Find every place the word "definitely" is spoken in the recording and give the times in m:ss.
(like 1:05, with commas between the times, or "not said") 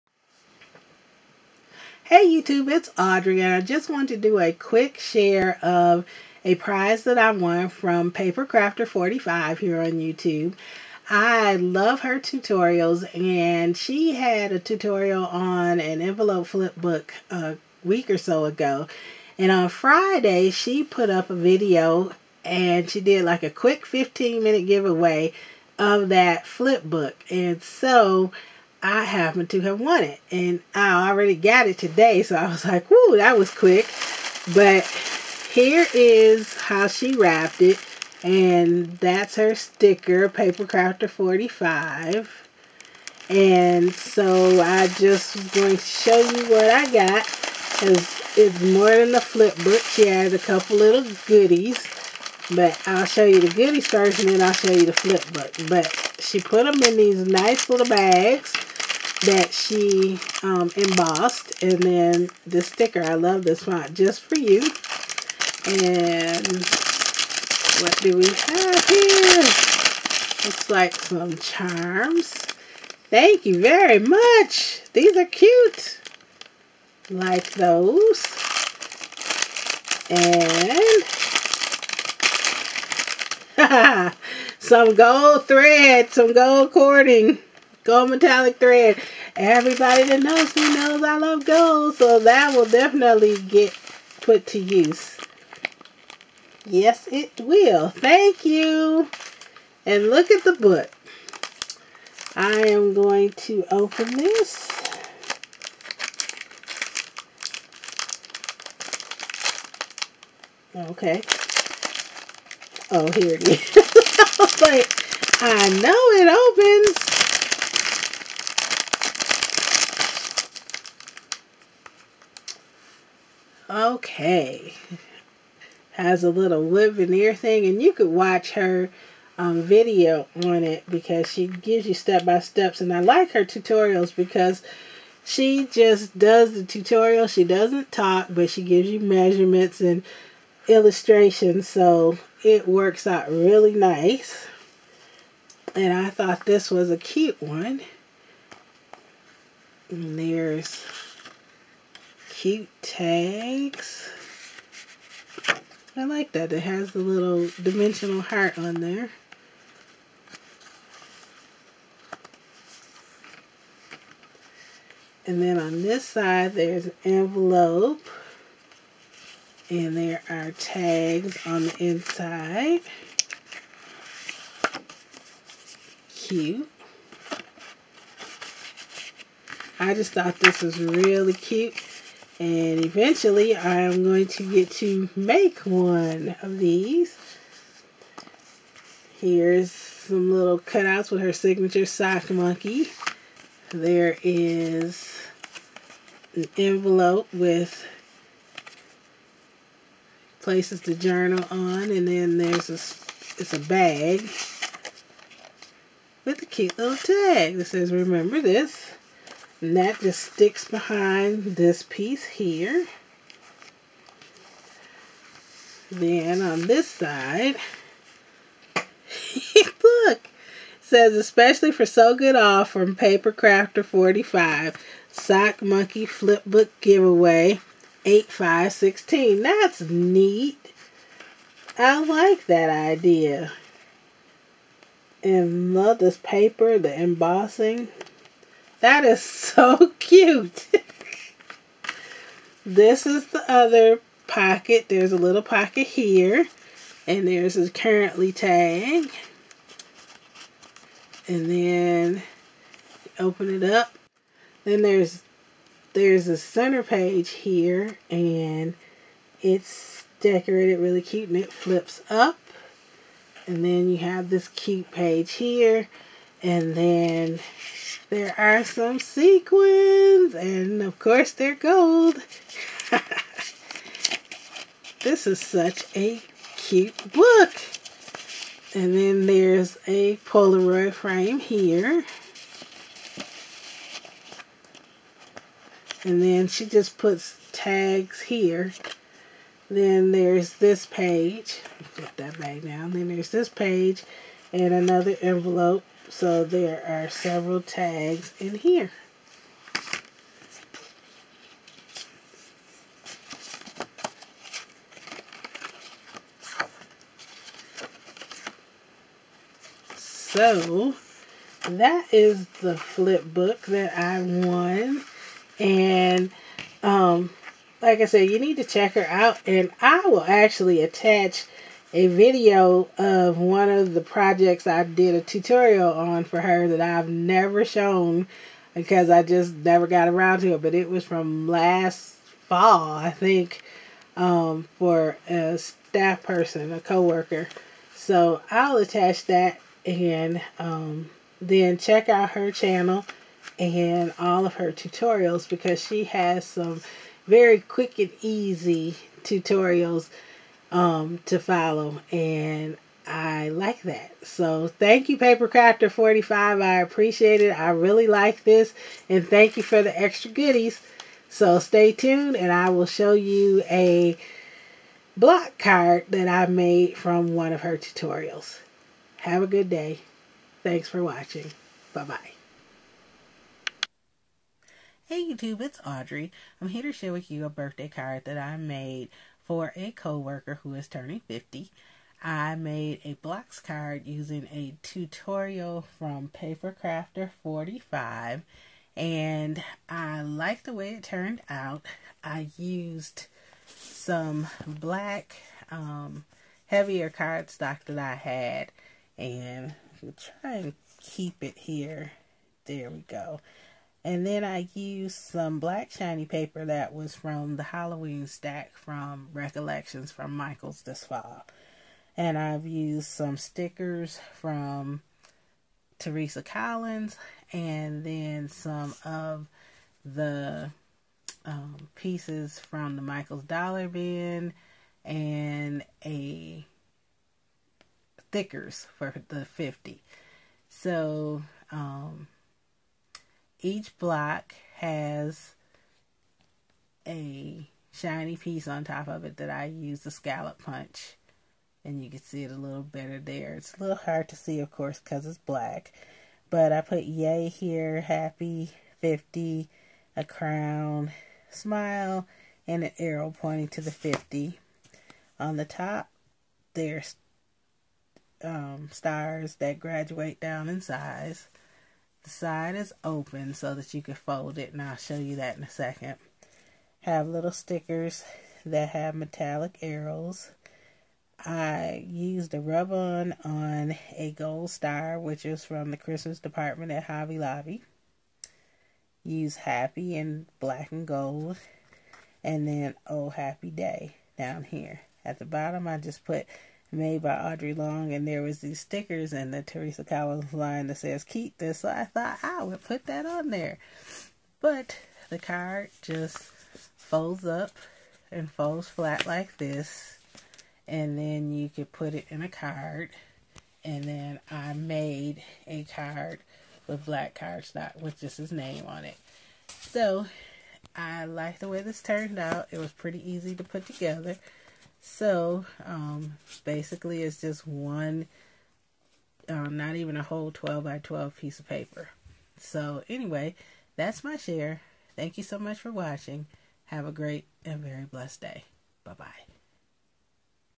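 1:32.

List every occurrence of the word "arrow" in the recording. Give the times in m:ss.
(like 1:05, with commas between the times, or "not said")
7:32, 7:49.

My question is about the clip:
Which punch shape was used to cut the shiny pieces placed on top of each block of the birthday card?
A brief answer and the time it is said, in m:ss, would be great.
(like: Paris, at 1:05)
scallop, at 7:20.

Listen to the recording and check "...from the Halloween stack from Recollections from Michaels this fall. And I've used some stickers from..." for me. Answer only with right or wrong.
right.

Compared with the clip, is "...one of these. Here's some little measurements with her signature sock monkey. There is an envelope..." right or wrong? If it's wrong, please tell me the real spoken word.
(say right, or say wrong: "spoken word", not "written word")
wrong: "cutouts", not "measurements".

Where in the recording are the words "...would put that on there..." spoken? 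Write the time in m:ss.
8:12.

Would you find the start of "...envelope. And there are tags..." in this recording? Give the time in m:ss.
2:47.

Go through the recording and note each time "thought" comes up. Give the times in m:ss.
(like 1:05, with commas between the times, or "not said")
2:26, 3:00, 8:12.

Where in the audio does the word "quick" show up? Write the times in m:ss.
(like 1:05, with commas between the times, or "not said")
0:04, 0:23, 0:33, 5:47.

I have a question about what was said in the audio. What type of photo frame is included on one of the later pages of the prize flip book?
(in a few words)
Polaroid frame.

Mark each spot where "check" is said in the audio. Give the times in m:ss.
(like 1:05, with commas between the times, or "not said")
5:18, 5:41.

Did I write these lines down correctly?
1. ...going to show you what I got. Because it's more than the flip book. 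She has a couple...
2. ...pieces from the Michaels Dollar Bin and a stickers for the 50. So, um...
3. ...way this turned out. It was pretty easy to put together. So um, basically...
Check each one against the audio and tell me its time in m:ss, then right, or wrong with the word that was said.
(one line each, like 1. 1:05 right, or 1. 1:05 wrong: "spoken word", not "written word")
1. 0:45 right
2. 7:01 right
3. 8:31 right.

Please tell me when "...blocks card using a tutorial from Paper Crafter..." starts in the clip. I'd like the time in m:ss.
6:23.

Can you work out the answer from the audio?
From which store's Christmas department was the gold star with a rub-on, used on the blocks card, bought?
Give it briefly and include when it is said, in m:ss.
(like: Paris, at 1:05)
Hobby Lobby, at 7:57.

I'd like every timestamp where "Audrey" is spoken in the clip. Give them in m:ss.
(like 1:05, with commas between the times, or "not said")
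0:02, 6:15, 8:07.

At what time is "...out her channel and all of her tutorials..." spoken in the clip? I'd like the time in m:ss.
5:42.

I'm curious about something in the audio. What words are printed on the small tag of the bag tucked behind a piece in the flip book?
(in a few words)
remember this.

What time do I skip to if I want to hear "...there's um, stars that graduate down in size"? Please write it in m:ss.
7:36.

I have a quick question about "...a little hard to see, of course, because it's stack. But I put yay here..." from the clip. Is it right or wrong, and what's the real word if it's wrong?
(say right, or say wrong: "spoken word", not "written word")
wrong: "black", not "stack".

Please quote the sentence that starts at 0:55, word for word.
But she put them in these nice little bags that she um, embossed.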